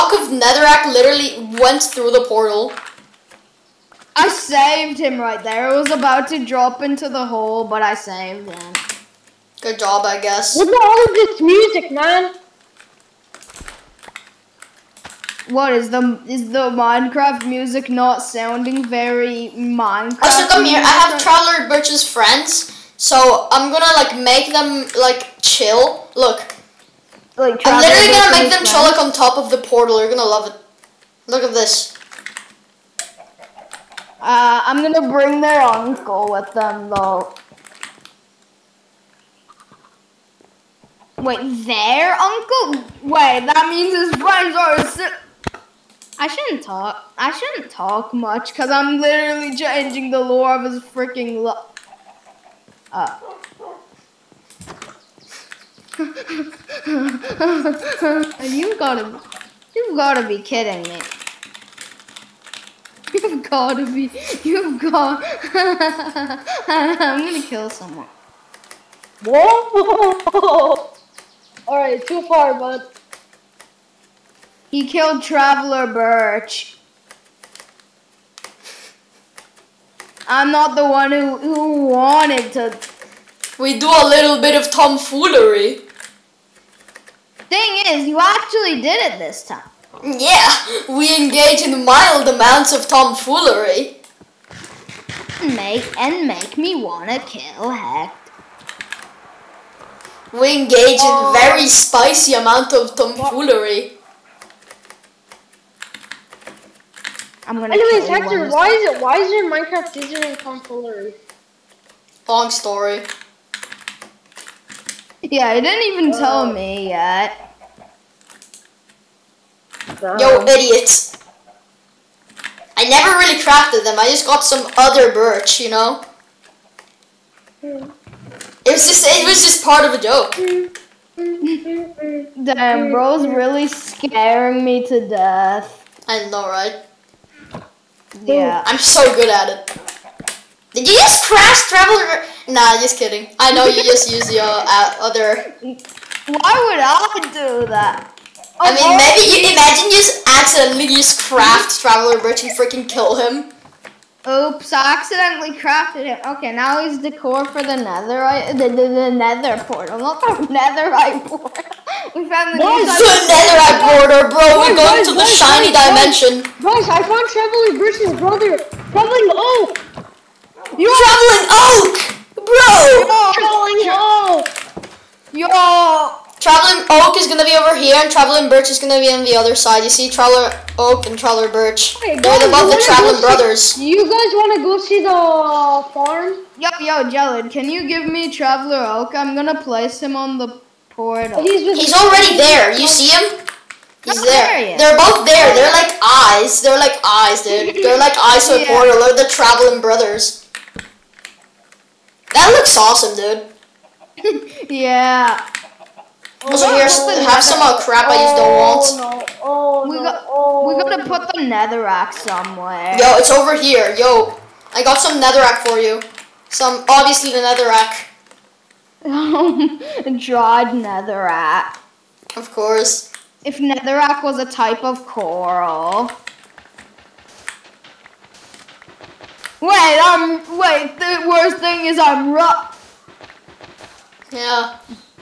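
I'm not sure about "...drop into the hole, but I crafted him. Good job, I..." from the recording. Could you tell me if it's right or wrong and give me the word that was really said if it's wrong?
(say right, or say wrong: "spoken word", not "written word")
wrong: "saved", not "crafted".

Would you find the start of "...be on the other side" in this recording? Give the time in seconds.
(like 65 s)
178 s.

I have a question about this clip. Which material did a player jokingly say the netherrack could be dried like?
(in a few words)
coral.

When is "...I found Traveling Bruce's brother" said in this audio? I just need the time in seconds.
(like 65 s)
166 s.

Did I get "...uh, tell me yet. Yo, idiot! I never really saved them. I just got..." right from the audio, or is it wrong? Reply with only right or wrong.
wrong.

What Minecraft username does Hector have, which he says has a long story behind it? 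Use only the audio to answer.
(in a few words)
Confolary.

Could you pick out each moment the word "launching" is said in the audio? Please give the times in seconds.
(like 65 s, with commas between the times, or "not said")
not said.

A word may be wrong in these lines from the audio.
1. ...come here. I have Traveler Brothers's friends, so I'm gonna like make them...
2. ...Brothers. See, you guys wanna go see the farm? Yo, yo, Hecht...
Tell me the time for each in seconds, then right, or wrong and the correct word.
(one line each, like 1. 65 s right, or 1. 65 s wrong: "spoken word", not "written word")
1. 20 s wrong: "Birch", not "Brothers"
2. 183 s wrong: "Jellard", not "Hecht".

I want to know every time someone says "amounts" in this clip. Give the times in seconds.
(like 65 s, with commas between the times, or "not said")
92 s, 102 s.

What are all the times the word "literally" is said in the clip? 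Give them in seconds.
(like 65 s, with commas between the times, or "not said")
0 s, 27 s, 48 s.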